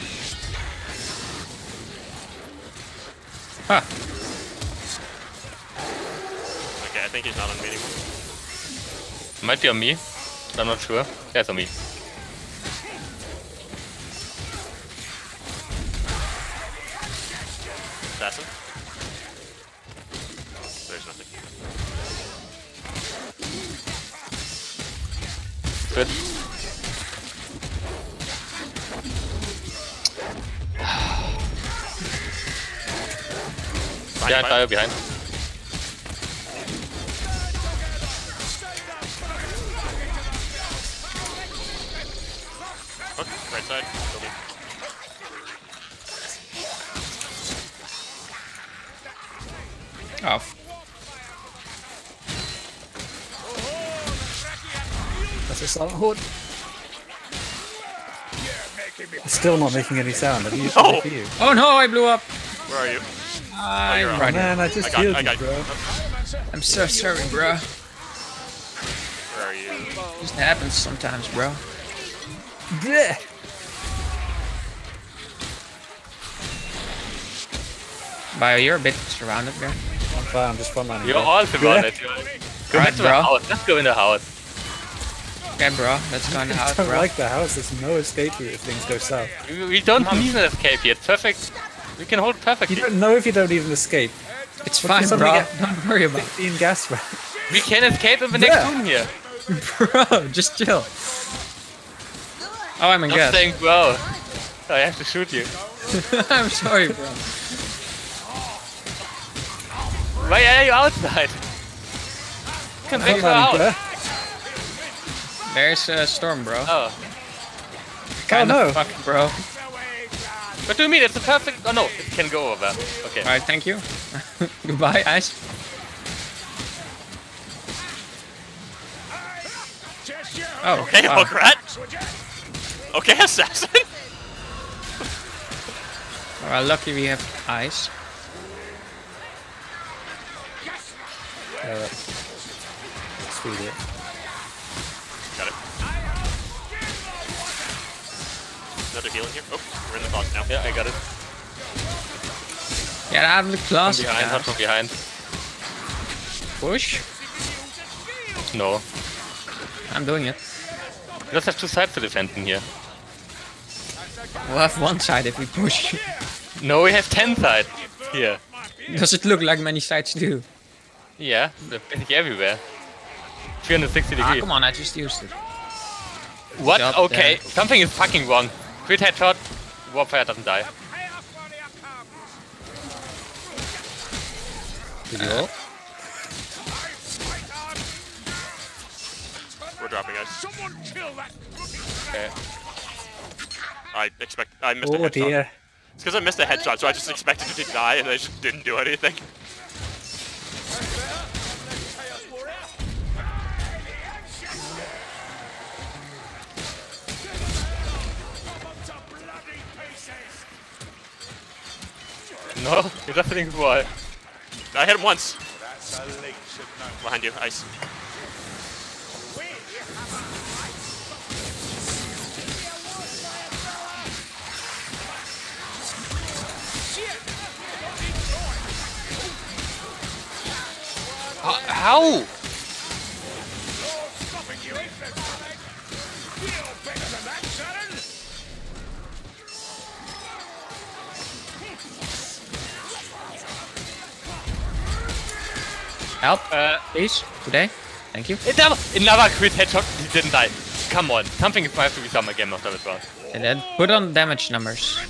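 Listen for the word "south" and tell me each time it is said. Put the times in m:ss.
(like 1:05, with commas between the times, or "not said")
1:28.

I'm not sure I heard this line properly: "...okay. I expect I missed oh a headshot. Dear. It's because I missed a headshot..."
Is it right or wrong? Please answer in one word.
right.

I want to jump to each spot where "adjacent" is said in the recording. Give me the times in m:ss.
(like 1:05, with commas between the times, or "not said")
not said.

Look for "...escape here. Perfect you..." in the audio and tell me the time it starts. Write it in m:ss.
1:30.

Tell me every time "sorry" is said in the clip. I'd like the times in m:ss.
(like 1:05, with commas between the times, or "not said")
1:06, 1:46.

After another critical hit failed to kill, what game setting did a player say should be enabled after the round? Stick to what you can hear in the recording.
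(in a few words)
damage numbers.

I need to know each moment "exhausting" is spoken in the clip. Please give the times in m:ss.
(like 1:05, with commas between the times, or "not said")
not said.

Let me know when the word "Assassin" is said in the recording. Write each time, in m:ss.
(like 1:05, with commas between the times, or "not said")
0:18, 2:13.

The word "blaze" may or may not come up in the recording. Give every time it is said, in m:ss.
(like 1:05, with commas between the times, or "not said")
not said.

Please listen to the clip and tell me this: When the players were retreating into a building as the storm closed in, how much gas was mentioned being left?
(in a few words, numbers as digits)
15.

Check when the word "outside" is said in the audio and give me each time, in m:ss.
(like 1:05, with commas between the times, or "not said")
1:50.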